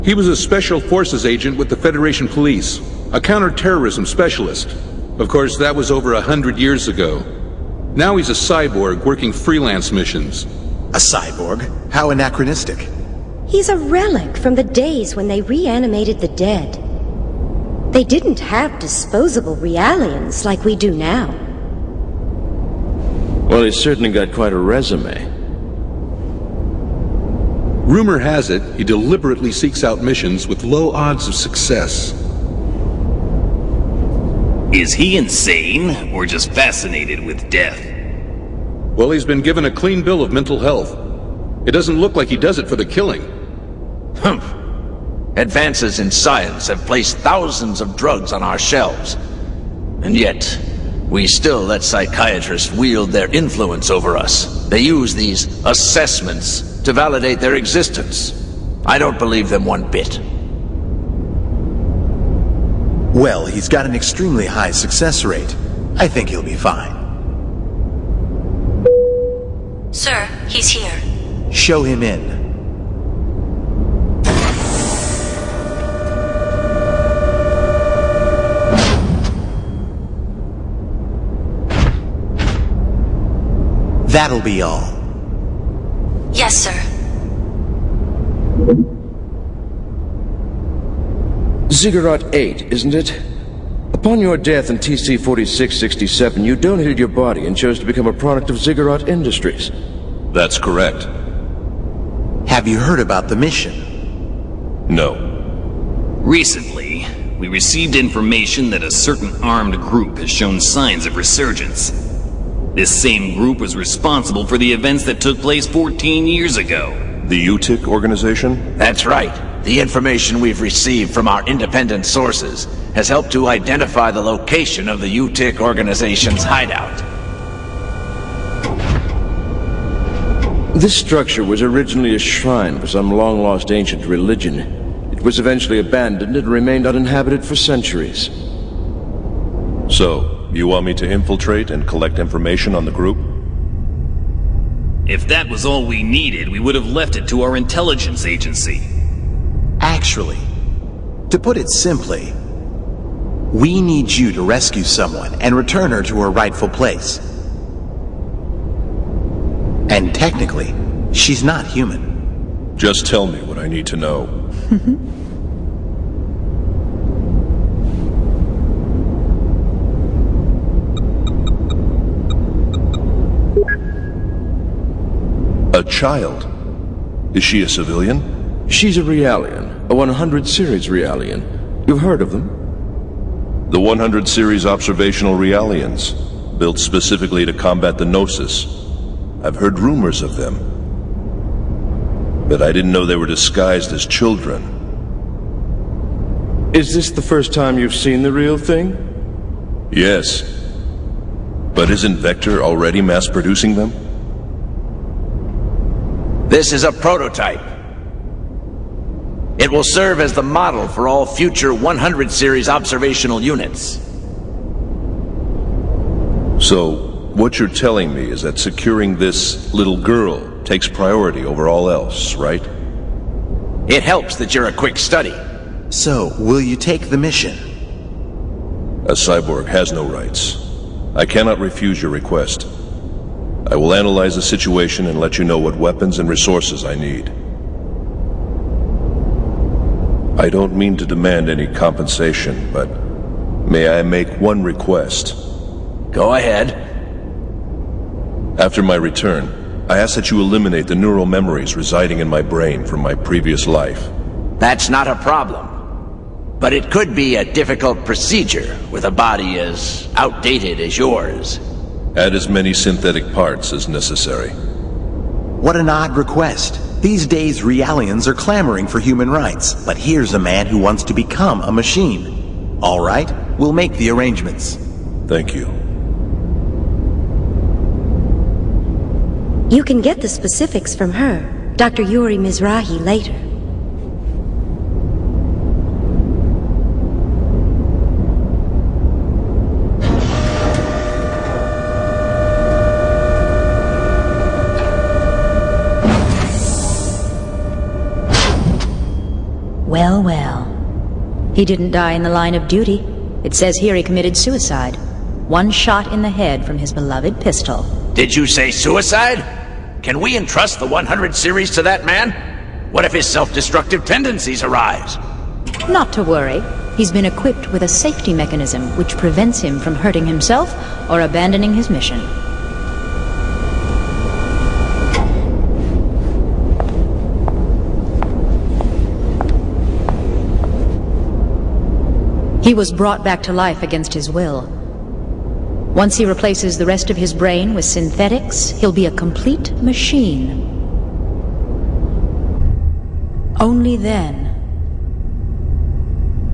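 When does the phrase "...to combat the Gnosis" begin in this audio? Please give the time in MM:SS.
03:07.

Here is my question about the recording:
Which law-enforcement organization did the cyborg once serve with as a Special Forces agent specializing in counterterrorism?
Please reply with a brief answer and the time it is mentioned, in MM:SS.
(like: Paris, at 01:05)
Federation Police, at 00:01.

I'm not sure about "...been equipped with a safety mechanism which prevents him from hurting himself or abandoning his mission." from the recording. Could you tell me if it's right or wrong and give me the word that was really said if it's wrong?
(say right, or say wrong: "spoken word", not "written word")
right.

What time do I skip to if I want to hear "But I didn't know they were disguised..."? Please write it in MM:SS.
03:12.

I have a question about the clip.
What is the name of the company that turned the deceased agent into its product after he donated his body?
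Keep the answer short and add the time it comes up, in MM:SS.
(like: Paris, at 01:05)
Ziggurat Industries, at 01:38.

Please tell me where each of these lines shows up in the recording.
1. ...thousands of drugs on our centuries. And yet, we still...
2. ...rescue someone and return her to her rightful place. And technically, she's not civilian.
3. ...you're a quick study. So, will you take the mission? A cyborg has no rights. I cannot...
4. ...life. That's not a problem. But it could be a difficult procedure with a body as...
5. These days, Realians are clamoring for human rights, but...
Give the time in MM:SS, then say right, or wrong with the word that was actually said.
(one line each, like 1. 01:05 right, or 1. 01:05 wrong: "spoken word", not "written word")
1. 00:47 wrong: "shelves", not "centuries"
2. 02:34 wrong: "human", not "civilian"
3. 03:44 right
4. 04:13 right
5. 04:26 right.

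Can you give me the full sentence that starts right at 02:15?
It was eventually abandoned and remained uninhabited for centuries.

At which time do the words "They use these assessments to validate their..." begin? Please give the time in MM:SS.
00:54.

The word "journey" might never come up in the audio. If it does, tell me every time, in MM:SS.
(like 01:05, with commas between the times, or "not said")
not said.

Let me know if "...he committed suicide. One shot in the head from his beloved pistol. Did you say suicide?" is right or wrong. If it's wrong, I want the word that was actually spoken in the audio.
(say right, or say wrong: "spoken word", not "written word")
right.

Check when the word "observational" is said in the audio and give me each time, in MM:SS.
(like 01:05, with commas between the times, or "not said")
03:04, 03:32.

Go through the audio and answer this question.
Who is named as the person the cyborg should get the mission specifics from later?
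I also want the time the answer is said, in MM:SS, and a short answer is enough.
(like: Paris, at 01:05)
Dr. Yuri Mizrahi, at 04:41.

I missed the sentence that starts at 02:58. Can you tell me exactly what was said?
She's a Realian, a 100 series Realian.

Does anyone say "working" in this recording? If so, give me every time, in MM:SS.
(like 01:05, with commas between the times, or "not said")
00:09.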